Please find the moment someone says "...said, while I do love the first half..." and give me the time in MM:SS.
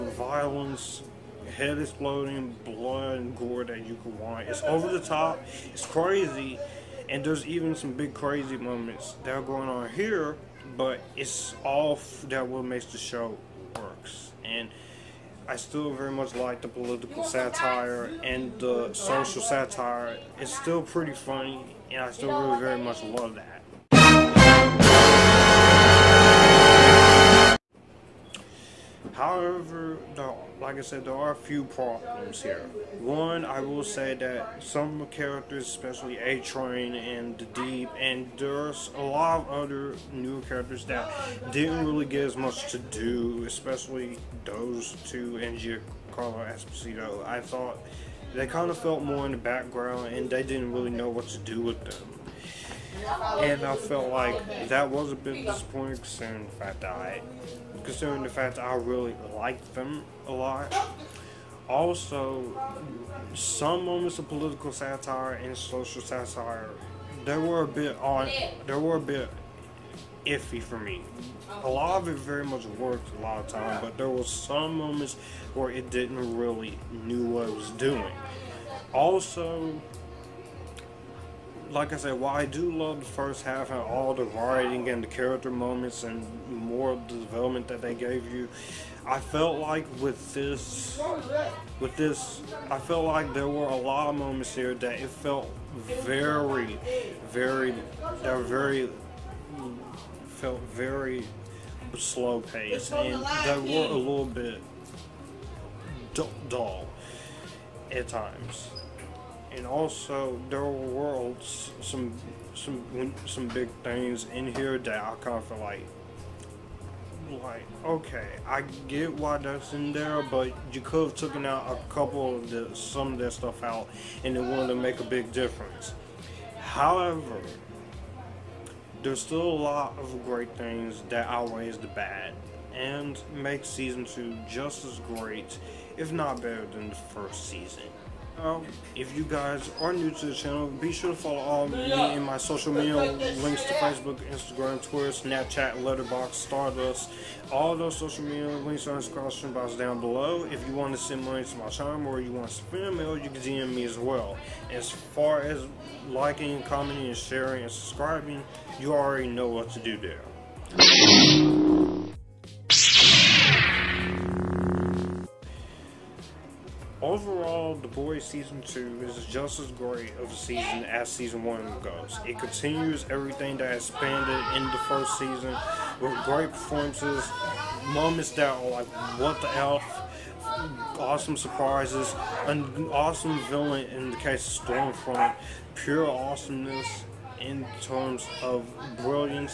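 01:21.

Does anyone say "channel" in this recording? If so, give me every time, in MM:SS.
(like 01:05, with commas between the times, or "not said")
02:20, 02:31.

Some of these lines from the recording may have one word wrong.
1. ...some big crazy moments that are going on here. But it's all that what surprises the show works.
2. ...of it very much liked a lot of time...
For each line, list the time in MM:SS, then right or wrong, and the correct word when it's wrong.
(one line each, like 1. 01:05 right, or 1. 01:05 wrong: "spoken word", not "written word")
1. 00:07 wrong: "makes", not "surprises"
2. 01:12 wrong: "worked", not "liked".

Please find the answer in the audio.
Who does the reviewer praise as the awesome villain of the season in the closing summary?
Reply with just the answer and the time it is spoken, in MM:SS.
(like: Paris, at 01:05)
Stormfront, at 03:04.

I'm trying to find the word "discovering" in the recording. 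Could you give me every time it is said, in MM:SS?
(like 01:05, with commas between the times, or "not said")
not said.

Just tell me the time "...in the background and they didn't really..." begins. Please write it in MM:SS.
00:49.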